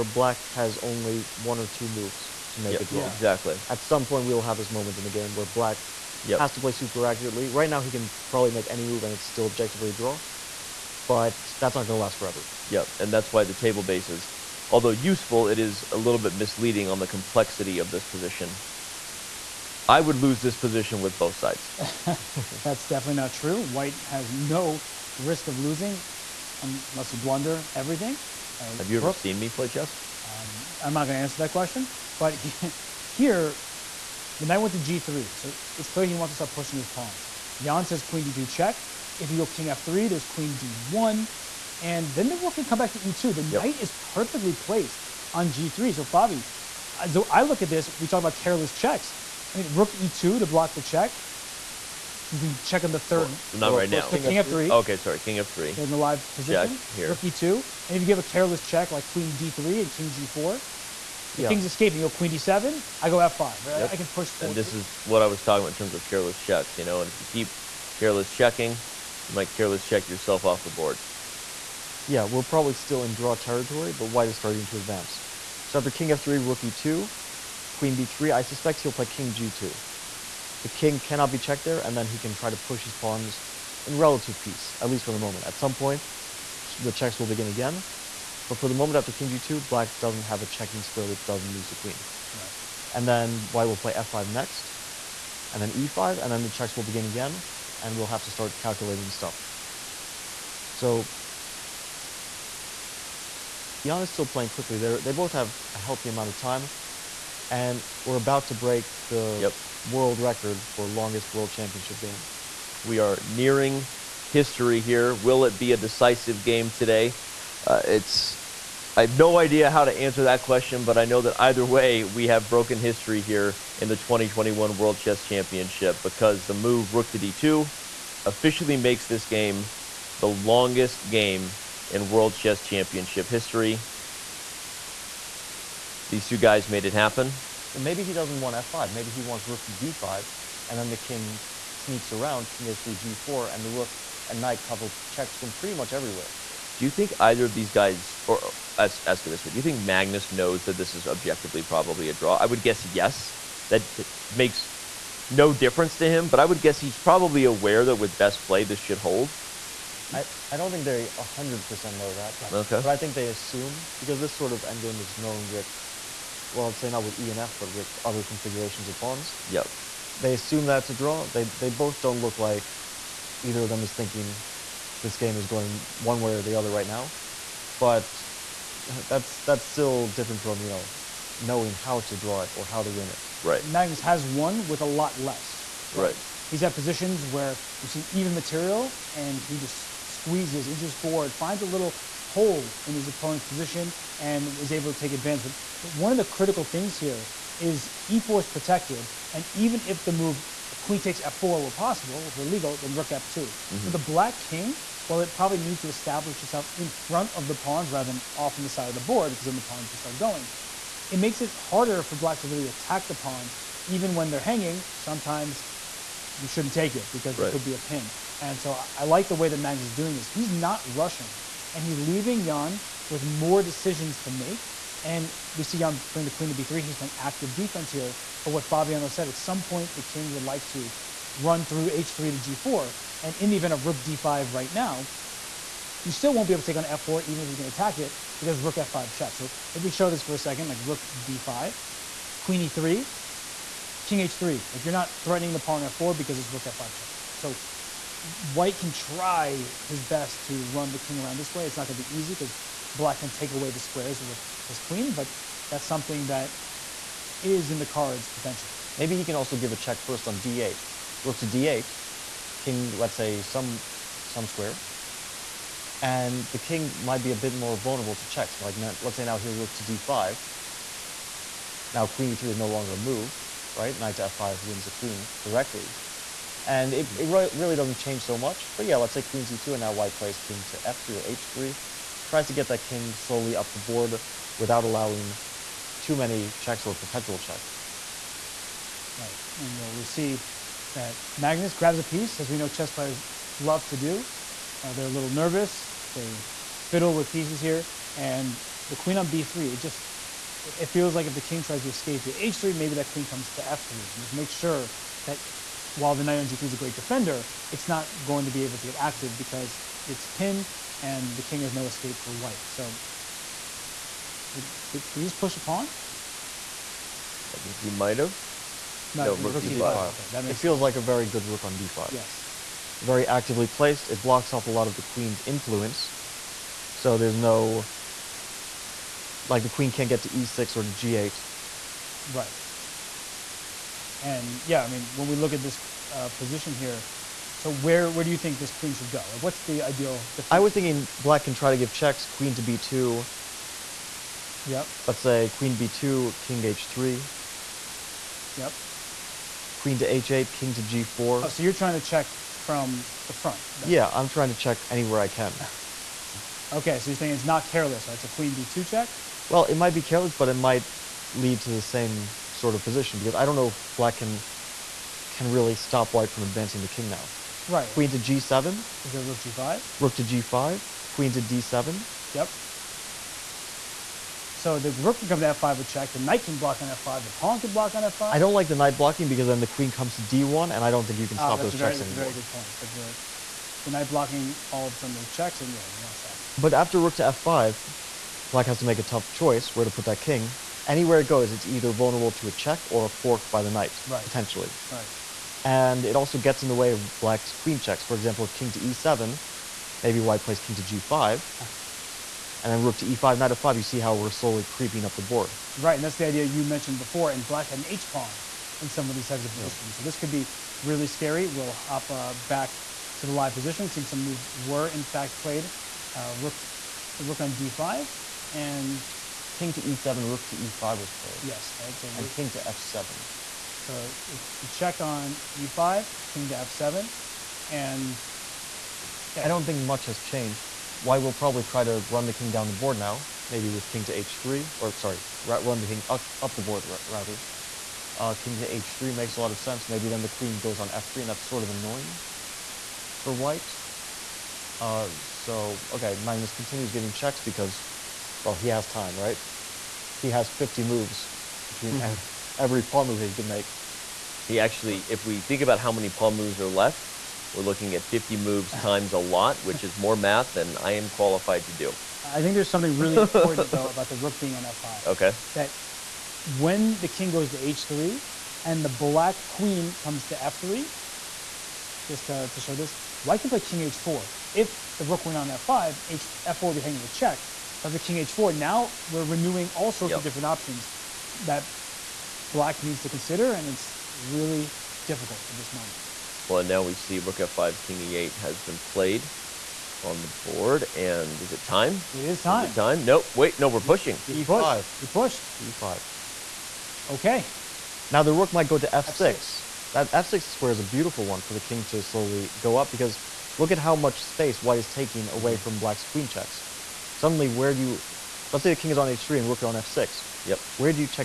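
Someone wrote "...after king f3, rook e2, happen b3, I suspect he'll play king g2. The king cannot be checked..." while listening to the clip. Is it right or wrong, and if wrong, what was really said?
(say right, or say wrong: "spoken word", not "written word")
wrong: "queen", not "happen".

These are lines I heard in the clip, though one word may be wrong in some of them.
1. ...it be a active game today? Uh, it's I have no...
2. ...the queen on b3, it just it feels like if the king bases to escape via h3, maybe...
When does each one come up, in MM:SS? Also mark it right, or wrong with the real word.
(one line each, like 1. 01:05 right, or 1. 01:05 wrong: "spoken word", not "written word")
1. 01:55 wrong: "decisive", not "active"
2. 04:58 wrong: "tries", not "bases".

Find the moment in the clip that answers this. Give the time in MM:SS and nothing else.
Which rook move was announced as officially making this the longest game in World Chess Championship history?
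02:06.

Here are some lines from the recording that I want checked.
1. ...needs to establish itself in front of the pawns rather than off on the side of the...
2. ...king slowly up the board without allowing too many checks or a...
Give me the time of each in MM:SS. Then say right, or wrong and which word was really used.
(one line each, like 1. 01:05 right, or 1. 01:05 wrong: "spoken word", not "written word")
1. 03:25 right
2. 04:42 right.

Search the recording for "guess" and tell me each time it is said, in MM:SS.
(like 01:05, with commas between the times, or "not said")
02:32, 02:36.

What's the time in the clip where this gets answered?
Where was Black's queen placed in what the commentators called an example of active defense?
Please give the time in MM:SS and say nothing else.
03:46.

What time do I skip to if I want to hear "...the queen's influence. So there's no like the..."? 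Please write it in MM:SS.
05:24.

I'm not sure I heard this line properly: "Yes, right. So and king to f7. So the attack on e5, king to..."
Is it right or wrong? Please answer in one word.
wrong.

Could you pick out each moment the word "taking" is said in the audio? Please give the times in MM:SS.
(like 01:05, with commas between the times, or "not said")
08:24.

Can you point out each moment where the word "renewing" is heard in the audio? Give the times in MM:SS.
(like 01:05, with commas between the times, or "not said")
07:59.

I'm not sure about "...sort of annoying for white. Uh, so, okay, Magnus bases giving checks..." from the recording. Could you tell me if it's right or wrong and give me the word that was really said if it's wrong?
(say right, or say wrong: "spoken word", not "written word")
wrong: "continues", not "bases".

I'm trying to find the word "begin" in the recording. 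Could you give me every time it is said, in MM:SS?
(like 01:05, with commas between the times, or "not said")
01:27, 01:36.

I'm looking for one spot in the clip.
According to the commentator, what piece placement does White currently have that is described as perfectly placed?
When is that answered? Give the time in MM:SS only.
00:43.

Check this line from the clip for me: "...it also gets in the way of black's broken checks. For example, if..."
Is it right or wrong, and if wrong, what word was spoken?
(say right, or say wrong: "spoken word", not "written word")
wrong: "queen", not "broken".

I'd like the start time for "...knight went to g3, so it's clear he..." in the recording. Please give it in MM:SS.
00:34.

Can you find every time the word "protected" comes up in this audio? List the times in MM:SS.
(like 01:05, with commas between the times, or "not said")
03:18.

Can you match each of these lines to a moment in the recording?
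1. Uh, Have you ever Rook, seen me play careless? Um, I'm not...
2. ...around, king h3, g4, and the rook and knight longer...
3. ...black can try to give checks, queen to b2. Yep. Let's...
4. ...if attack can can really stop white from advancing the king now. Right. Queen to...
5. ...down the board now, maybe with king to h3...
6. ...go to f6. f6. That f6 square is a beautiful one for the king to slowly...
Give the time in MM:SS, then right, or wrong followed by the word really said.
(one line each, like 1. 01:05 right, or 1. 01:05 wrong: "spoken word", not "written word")
1. 00:28 wrong: "chess", not "careless"
2. 02:22 wrong: "cover", not "longer"
3. 05:41 right
4. 06:03 wrong: "black", not "attack"
5. 07:12 right
6. 08:18 right.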